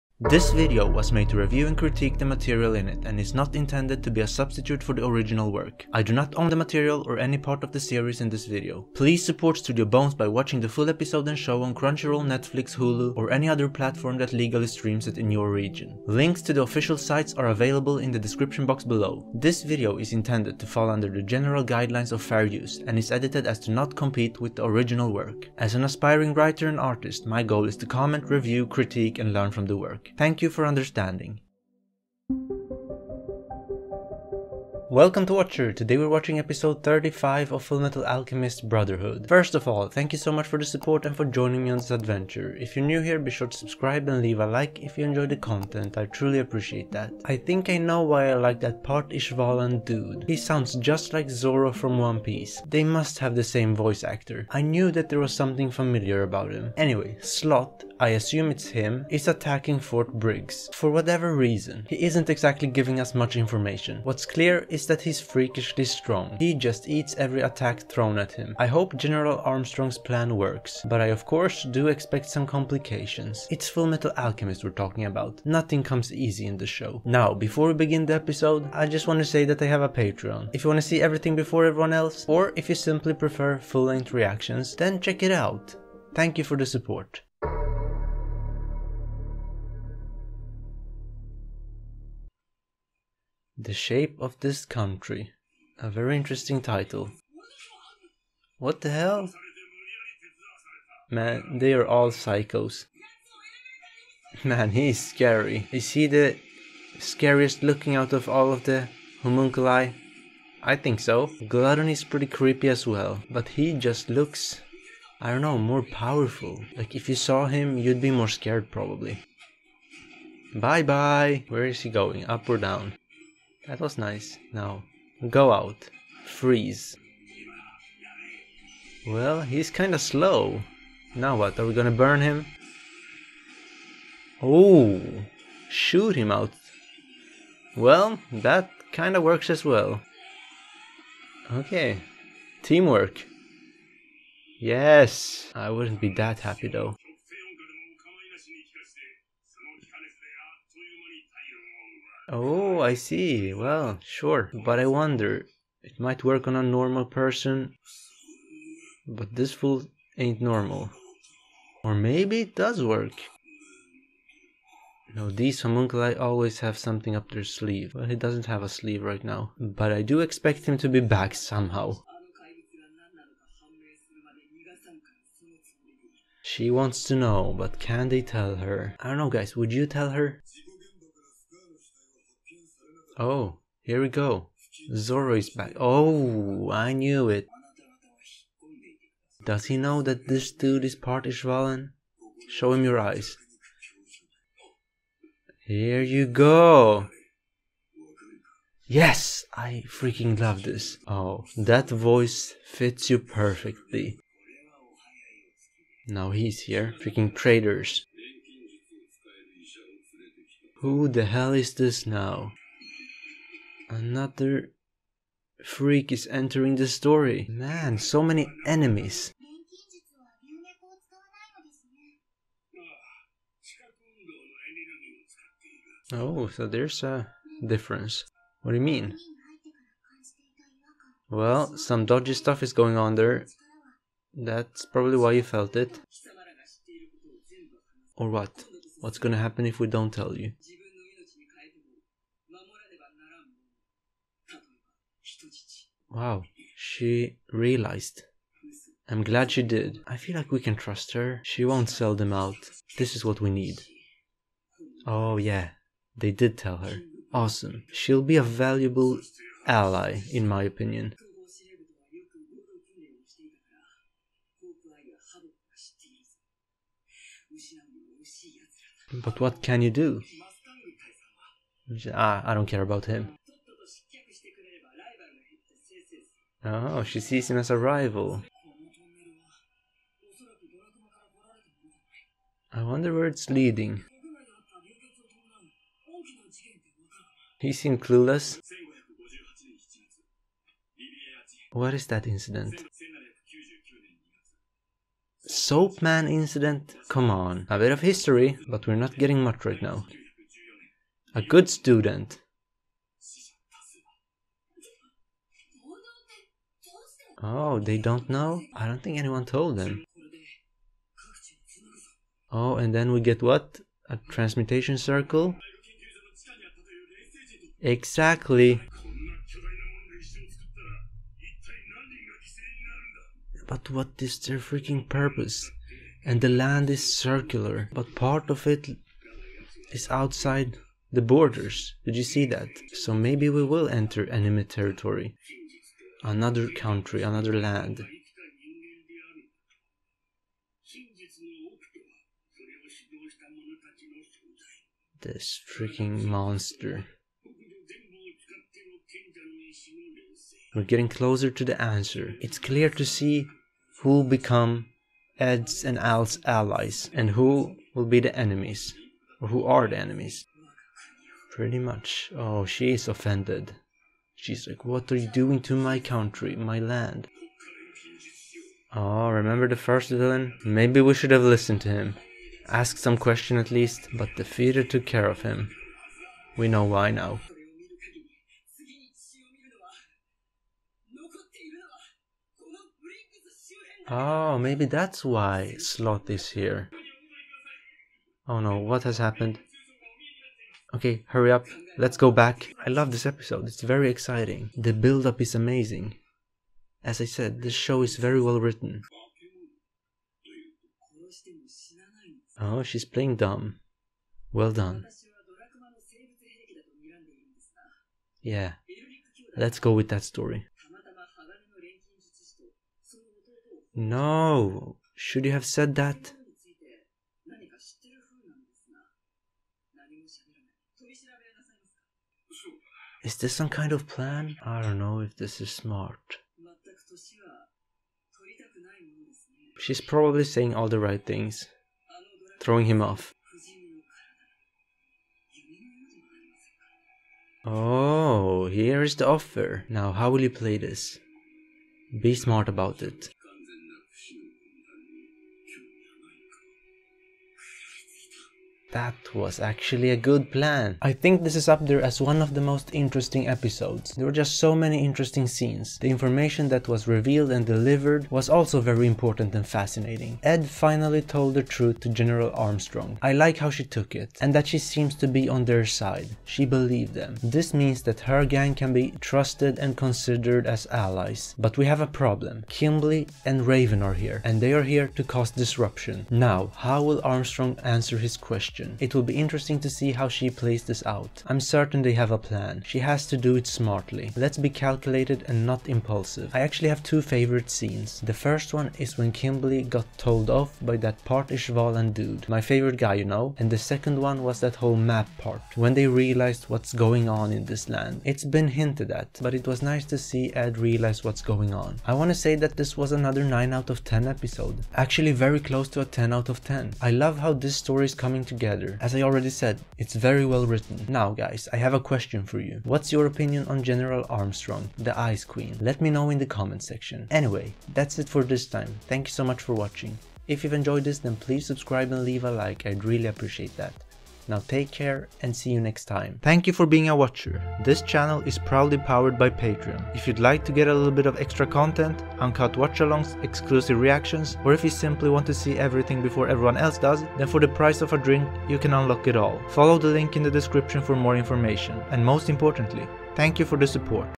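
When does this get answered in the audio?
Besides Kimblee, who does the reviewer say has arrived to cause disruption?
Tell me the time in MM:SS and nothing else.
07:53.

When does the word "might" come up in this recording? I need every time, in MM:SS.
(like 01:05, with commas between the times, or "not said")
02:35.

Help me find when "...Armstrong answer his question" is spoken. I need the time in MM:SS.
07:57.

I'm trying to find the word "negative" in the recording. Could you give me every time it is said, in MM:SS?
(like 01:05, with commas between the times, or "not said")
not said.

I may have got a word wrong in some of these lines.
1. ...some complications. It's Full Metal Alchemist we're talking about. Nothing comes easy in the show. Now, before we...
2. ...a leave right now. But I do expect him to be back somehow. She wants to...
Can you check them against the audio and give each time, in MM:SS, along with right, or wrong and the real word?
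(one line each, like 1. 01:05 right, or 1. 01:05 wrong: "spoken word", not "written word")
1. 01:12 right
2. 02:48 wrong: "sleeve", not "leave".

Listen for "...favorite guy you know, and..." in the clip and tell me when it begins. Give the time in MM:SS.
08:12.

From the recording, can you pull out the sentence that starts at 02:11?
Now what, are we gonna burn him?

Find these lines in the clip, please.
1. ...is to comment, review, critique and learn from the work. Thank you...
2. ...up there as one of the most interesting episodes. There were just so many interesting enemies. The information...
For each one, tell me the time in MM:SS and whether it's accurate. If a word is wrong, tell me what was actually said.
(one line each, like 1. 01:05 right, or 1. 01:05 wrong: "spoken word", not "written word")
1. 00:27 right
2. 07:31 wrong: "scenes", not "enemies".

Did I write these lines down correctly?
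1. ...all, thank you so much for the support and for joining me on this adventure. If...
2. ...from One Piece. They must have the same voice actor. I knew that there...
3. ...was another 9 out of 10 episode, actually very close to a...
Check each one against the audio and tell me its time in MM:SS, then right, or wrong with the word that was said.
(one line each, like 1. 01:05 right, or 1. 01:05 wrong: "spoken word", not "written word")
1. 00:39 right
2. 00:51 right
3. 08:22 right.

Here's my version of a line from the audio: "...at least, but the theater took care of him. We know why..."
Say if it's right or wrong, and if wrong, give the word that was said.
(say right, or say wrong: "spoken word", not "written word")
right.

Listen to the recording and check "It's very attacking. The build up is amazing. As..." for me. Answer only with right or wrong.
wrong.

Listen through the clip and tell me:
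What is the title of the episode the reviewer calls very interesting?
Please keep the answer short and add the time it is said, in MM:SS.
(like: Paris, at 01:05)
The Shape of This Country, at 01:33.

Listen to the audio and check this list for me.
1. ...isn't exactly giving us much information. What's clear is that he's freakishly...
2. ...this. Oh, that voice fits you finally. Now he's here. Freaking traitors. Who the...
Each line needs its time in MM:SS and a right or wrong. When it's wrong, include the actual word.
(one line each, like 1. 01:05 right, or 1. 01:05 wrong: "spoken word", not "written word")
1. 01:02 right
2. 03:20 wrong: "perfectly", not "finally".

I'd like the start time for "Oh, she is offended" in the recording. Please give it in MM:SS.
06:02.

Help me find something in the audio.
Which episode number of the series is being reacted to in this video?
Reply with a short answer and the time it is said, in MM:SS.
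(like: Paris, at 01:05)
35, at 00:36.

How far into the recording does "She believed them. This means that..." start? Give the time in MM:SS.
07:46.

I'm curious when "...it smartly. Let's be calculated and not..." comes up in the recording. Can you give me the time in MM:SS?
08:03.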